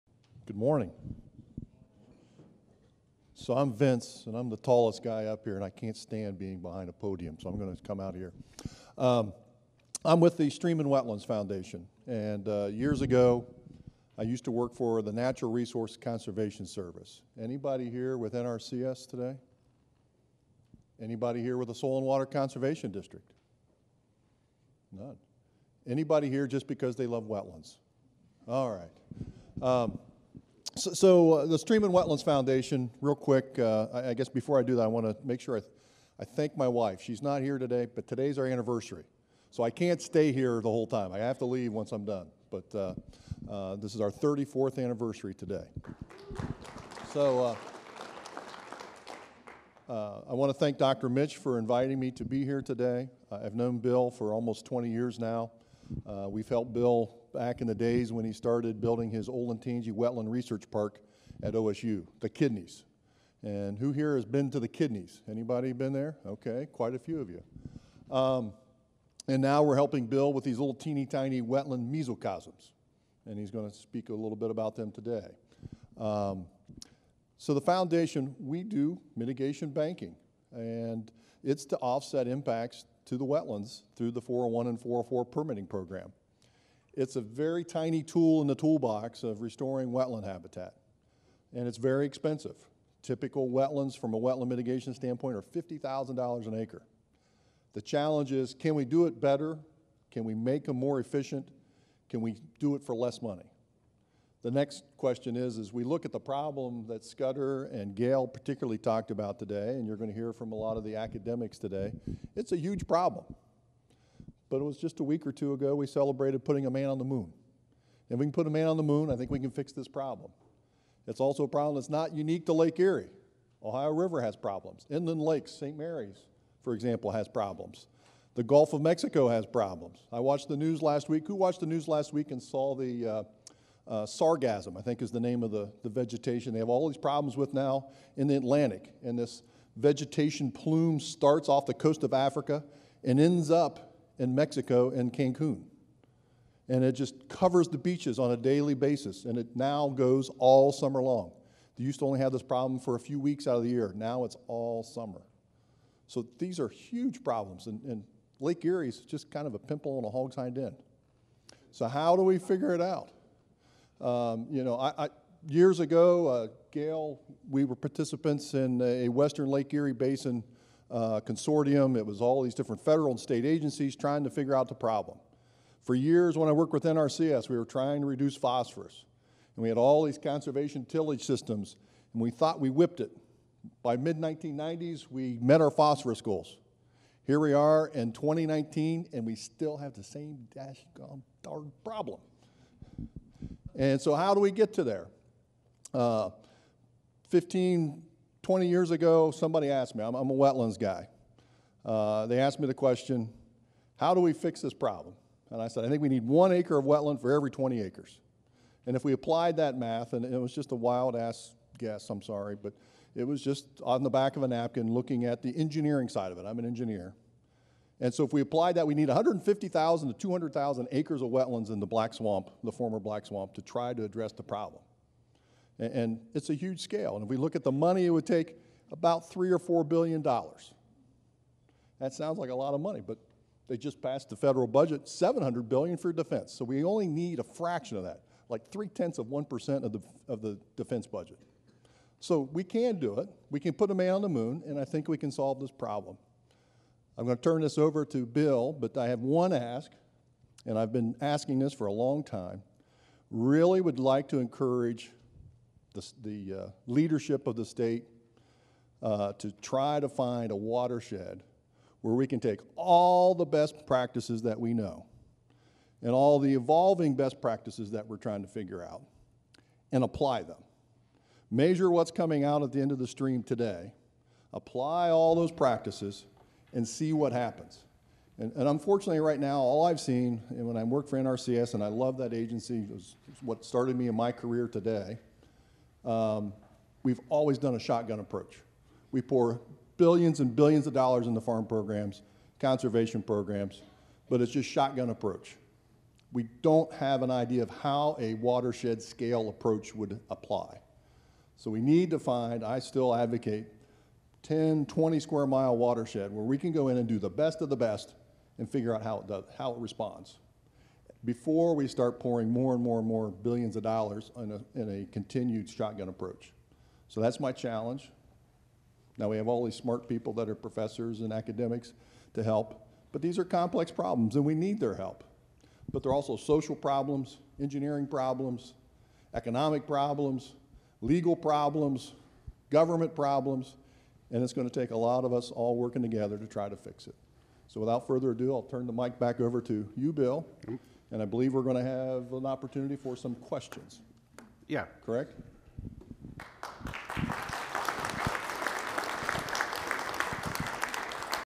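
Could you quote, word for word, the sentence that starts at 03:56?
So we only need a fraction of that, like three tenths of 1% of the, of the defense budget.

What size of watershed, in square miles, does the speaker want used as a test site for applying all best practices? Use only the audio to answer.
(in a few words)
10 to 20 square miles.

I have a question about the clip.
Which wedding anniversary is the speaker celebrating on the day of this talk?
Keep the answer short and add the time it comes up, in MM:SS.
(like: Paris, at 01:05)
34th, at 00:44.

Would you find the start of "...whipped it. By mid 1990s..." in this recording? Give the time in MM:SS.
03:02.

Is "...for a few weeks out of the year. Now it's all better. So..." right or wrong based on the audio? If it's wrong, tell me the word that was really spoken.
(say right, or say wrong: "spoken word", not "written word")
wrong: "summer", not "better".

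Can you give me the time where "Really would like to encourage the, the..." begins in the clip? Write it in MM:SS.
04:13.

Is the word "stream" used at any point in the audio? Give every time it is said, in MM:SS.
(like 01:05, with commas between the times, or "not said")
00:10, 00:31, 04:33.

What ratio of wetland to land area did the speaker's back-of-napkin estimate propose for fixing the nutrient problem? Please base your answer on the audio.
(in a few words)
1 acre per 20 acres.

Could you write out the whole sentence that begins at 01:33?
Typical wetlands, from a wetland mitigation standpoint, are $50,000 an acre.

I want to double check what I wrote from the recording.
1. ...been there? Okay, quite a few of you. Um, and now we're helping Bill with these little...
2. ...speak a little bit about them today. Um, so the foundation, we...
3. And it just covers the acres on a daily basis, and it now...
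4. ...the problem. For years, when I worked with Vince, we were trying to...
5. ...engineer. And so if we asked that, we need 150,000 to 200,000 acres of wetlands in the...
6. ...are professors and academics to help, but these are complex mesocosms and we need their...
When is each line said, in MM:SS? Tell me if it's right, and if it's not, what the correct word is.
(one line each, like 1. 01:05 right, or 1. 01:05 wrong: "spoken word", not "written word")
1. 01:05 right
2. 01:13 right
3. 02:26 wrong: "beaches", not "acres"
4. 02:54 wrong: "NRCS", not "Vince"
5. 03:36 wrong: "applied", not "asked"
6. 05:20 wrong: "problems", not "mesocosms".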